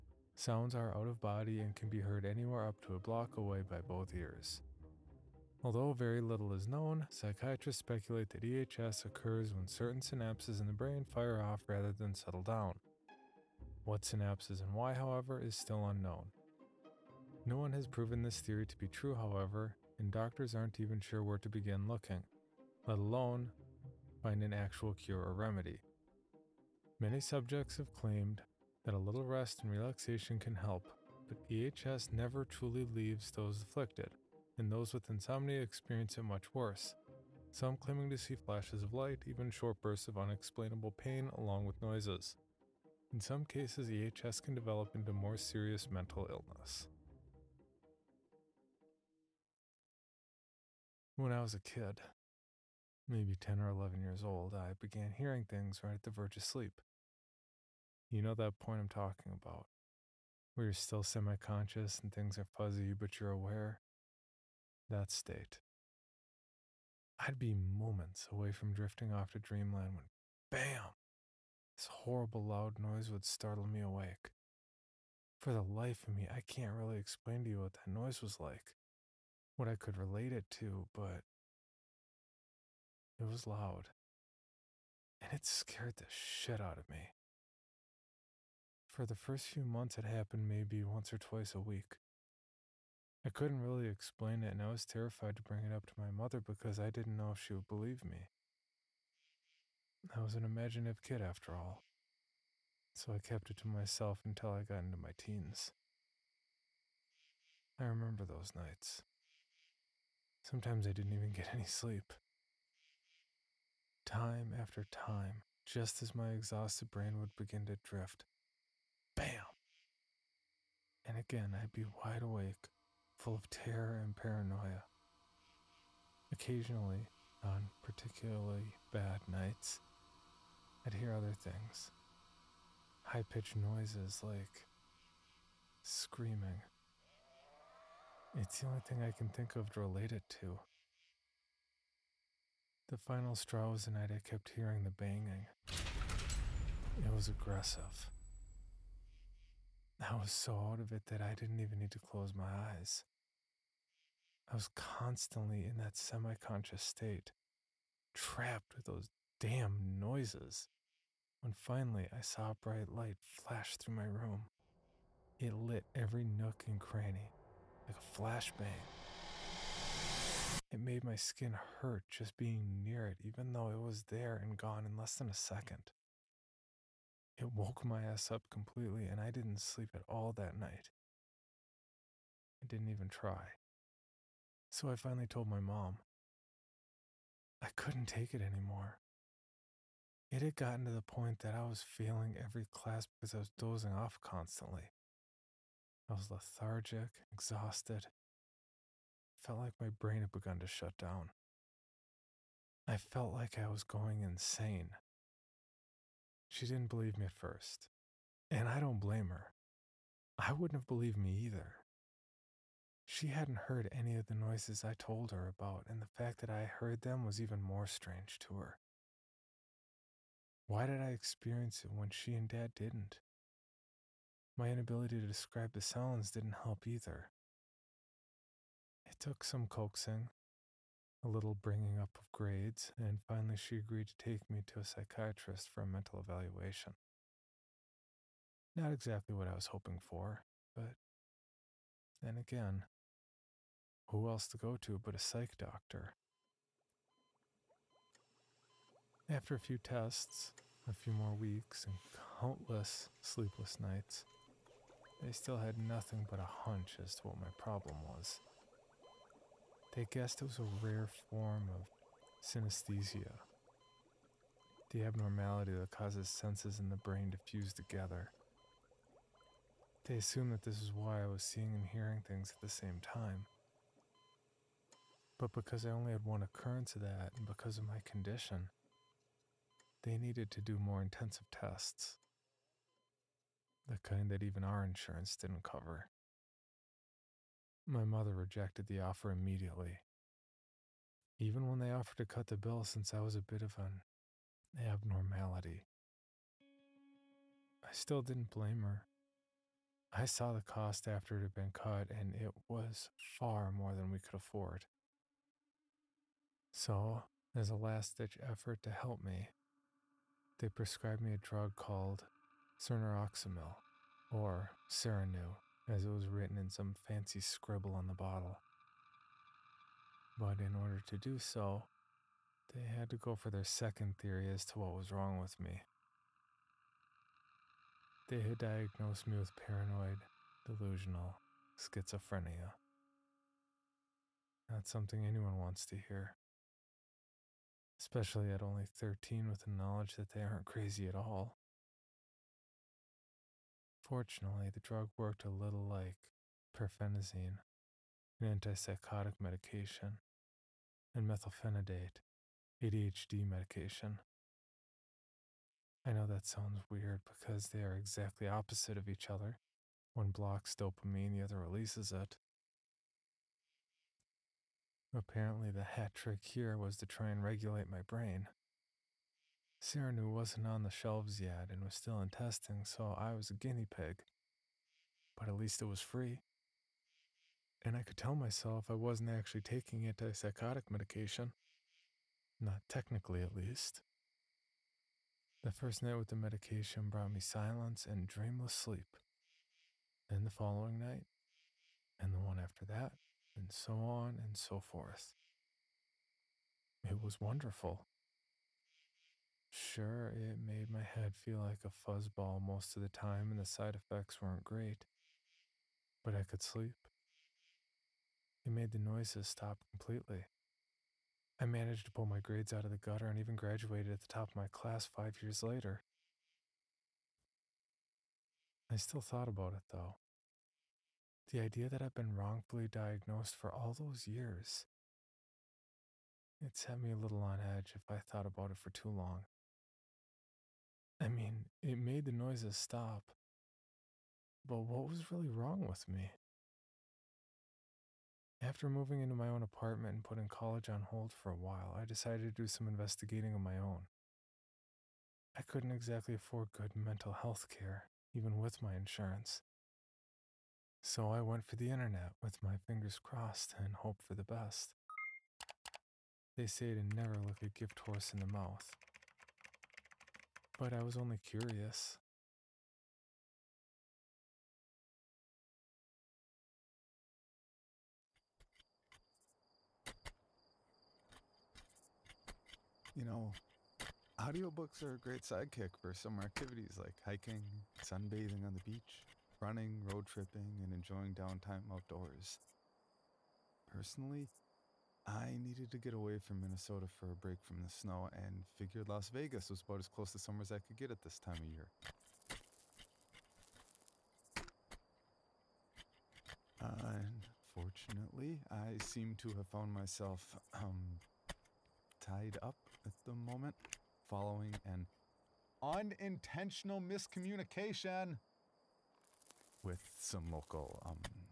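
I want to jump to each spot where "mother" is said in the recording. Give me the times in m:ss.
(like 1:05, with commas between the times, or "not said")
1:36, 4:48.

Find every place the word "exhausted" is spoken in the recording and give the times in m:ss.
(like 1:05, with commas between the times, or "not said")
1:56, 3:17.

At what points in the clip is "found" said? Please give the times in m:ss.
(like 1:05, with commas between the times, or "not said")
8:19.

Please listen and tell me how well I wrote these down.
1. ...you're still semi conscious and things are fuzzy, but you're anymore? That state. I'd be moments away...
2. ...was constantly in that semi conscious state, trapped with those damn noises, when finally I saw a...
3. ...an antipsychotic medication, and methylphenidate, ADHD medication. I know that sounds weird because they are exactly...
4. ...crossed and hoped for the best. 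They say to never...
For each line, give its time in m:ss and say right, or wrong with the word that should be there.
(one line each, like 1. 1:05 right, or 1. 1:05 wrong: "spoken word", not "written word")
1. 1:00 wrong: "aware", not "anymore"
2. 2:34 right
3. 5:48 right
4. 7:33 right.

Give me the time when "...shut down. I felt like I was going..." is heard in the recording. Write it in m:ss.
3:20.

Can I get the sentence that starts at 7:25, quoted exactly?
I couldn't exactly afford good mental health care, even with my insurance.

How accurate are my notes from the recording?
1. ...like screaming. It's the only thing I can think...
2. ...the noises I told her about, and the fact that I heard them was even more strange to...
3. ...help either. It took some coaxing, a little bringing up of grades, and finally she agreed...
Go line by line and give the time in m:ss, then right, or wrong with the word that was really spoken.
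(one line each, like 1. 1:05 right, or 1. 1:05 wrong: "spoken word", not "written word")
1. 2:14 right
2. 3:34 right
3. 3:46 right.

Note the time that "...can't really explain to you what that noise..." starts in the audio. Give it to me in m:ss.
1:16.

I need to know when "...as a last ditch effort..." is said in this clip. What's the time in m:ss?
5:07.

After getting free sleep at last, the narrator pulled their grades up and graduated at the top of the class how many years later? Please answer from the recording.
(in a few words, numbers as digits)
5 years.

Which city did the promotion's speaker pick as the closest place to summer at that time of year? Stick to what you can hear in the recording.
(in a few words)
Las Vegas.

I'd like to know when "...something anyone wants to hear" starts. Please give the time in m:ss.
5:34.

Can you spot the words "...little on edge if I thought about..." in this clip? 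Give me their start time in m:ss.
7:07.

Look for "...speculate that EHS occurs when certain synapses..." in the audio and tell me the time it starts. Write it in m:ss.
0:07.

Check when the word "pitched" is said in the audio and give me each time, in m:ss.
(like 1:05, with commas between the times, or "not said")
2:13.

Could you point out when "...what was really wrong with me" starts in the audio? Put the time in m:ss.
7:14.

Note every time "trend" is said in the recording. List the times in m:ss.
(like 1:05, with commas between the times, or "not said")
not said.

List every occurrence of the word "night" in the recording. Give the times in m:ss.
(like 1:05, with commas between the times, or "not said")
1:48, 2:09, 2:23, 3:00, 4:13, 6:26, 6:30.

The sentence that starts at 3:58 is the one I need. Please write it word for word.
Not exactly what I was hoping for, but then again, who else to go to but a psych doctor?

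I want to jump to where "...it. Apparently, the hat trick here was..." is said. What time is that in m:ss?
6:02.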